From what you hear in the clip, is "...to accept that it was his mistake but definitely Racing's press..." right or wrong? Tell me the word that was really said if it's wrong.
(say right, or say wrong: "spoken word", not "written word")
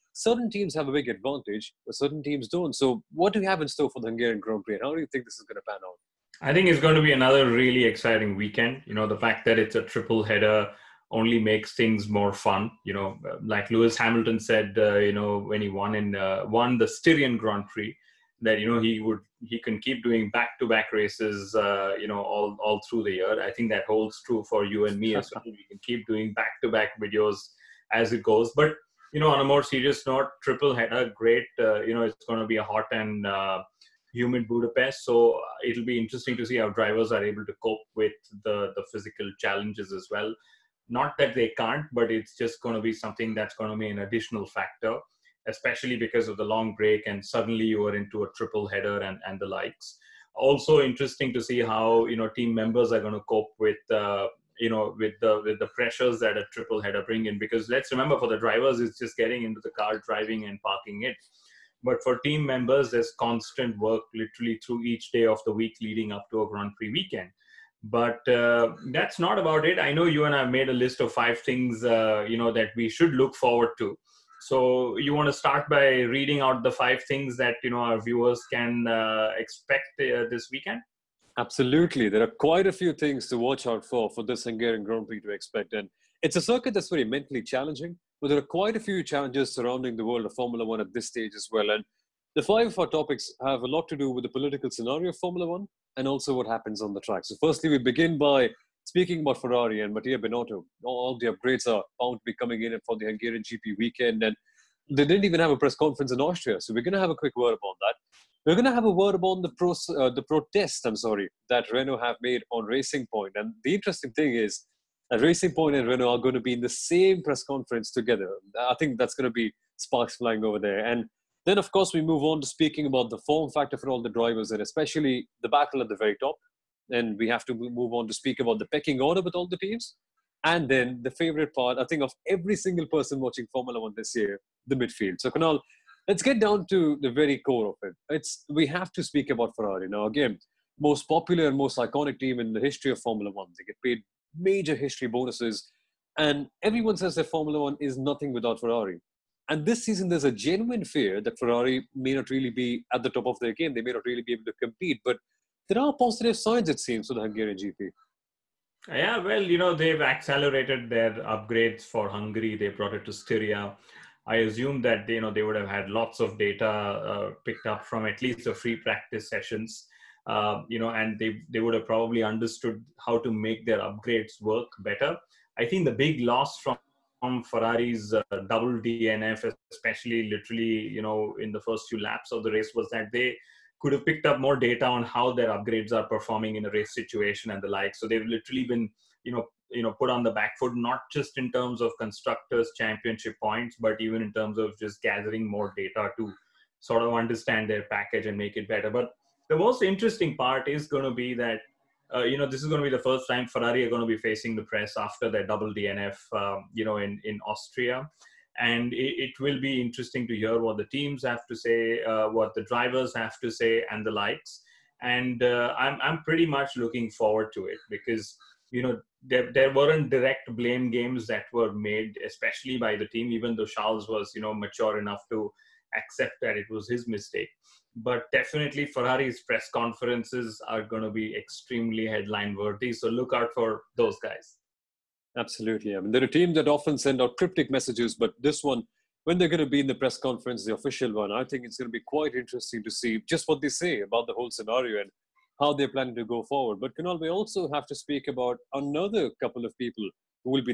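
wrong: "Ferrari", not "Racing".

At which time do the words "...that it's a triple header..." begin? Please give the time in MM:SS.
00:09.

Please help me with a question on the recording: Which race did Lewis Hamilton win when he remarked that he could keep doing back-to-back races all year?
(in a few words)
Styrian Grand Prix.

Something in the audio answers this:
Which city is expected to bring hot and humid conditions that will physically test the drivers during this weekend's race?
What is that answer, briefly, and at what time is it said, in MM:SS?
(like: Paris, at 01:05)
Budapest, at 00:34.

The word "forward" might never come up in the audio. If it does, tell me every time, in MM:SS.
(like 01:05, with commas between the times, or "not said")
01:13, 03:37, 04:06.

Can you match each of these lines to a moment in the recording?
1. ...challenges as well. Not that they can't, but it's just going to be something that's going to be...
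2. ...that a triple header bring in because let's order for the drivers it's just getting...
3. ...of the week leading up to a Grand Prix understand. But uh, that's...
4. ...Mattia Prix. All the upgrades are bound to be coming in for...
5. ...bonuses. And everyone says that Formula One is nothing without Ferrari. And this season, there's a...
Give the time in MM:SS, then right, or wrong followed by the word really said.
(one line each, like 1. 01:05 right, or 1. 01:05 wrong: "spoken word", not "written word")
1. 00:39 right
2. 00:56 wrong: "remember", not "order"
3. 01:05 wrong: "weekend", not "understand"
4. 01:39 wrong: "Binotto", not "Prix"
5. 02:25 right.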